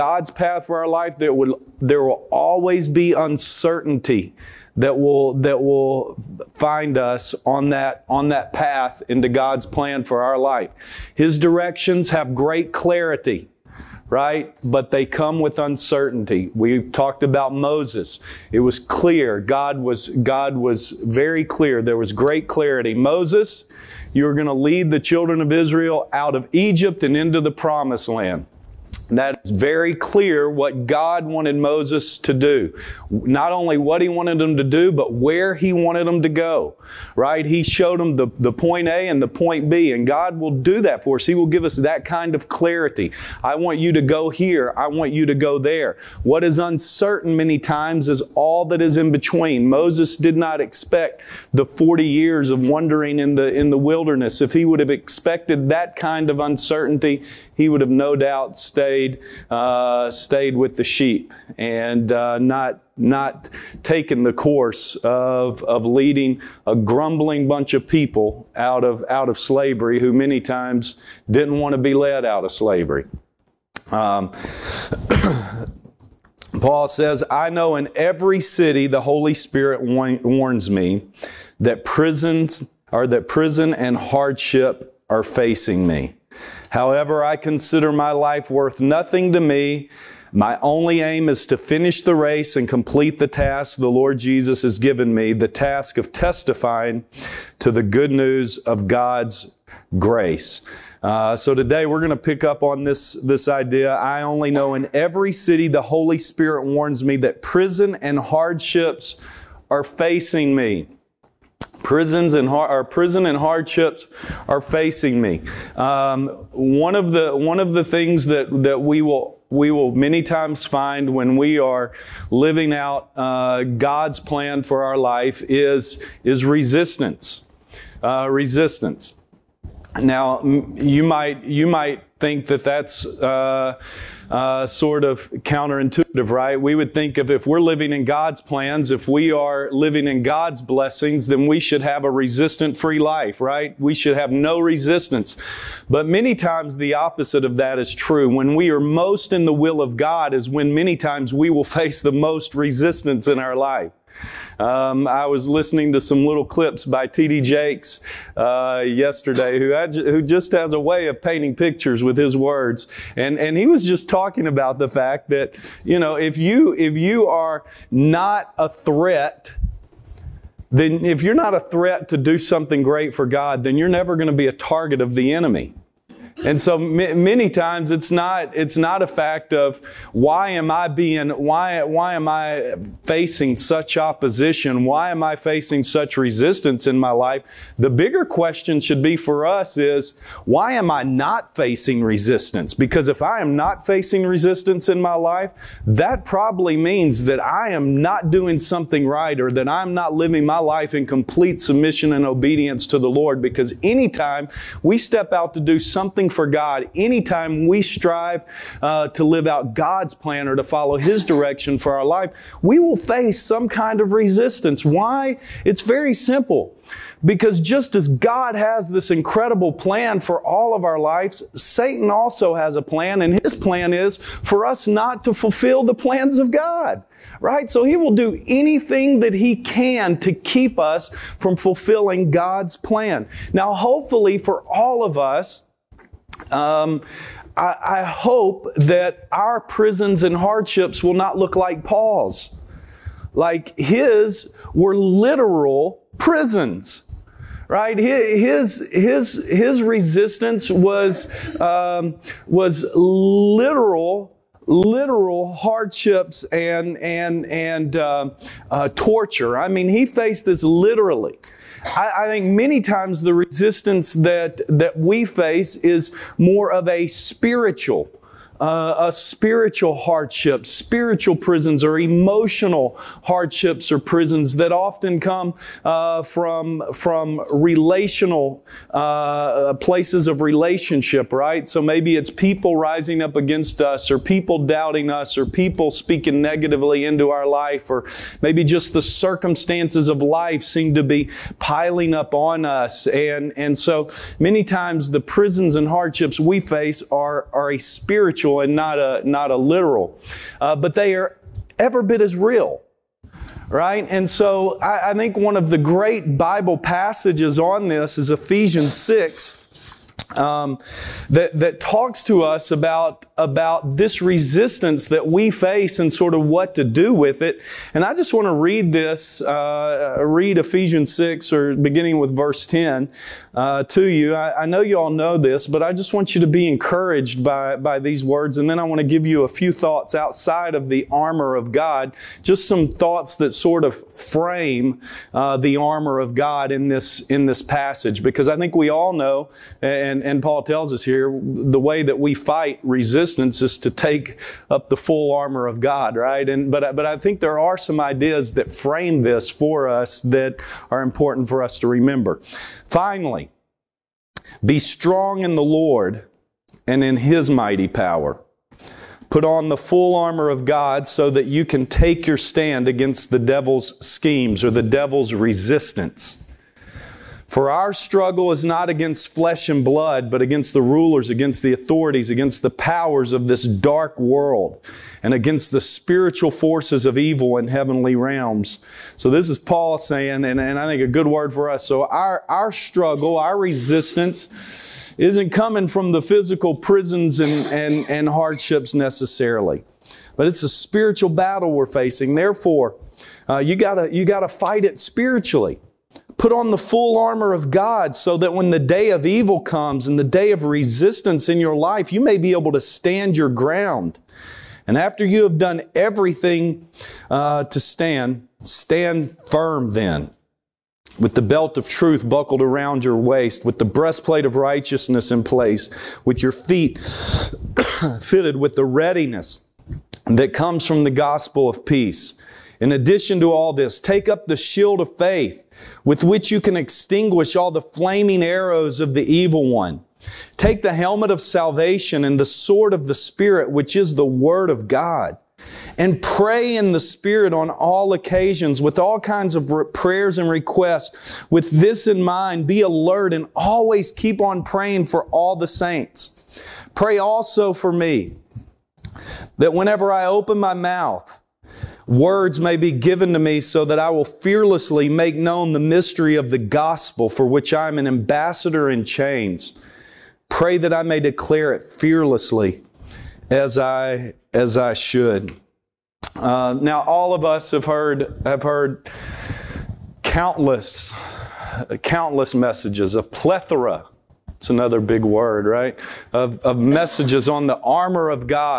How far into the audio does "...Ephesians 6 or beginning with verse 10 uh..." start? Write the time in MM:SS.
05:20.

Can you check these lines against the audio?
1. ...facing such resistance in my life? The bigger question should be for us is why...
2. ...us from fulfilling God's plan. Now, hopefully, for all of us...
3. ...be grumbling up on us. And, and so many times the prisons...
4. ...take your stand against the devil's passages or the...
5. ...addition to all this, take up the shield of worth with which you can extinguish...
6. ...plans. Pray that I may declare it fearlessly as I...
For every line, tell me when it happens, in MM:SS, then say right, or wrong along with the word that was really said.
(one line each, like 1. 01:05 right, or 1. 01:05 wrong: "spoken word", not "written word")
1. 03:05 right
2. 03:50 right
3. 04:51 wrong: "piling", not "grumbling"
4. 06:01 wrong: "schemes", not "passages"
5. 07:02 wrong: "faith", not "worth"
6. 07:39 wrong: "chains", not "plans".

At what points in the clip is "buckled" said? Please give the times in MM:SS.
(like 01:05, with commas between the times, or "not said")
06:52.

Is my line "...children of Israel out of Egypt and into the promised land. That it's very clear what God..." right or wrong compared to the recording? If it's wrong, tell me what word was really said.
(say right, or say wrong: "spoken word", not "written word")
right.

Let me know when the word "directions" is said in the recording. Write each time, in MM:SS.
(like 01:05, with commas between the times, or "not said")
00:11, 03:31.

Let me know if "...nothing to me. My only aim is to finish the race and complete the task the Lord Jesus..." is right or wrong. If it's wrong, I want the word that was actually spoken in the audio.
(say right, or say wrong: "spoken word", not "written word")
right.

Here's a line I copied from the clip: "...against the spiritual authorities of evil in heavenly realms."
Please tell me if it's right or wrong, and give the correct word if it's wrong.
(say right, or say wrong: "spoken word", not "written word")
wrong: "forces", not "authorities".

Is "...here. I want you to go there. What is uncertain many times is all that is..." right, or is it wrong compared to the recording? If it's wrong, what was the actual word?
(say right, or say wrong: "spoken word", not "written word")
right.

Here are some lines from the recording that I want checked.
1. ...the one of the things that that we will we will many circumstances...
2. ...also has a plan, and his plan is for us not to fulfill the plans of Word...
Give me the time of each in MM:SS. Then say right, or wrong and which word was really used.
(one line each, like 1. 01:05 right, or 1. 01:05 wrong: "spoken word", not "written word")
1. 01:57 wrong: "times", not "circumstances"
2. 03:42 wrong: "God", not "Word".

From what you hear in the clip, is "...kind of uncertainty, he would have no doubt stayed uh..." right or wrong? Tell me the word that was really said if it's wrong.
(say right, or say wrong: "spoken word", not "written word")
right.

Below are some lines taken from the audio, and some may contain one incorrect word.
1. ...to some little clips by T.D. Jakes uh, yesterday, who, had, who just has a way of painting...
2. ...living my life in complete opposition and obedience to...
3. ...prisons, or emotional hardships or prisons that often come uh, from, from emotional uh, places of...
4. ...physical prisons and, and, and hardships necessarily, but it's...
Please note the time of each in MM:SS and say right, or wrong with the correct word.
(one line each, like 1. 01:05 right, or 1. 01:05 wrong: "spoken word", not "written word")
1. 02:35 right
2. 03:20 wrong: "submission", not "opposition"
3. 04:31 wrong: "relational", not "emotional"
4. 06:26 right.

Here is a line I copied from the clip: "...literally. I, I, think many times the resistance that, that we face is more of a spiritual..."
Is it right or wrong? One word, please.
right.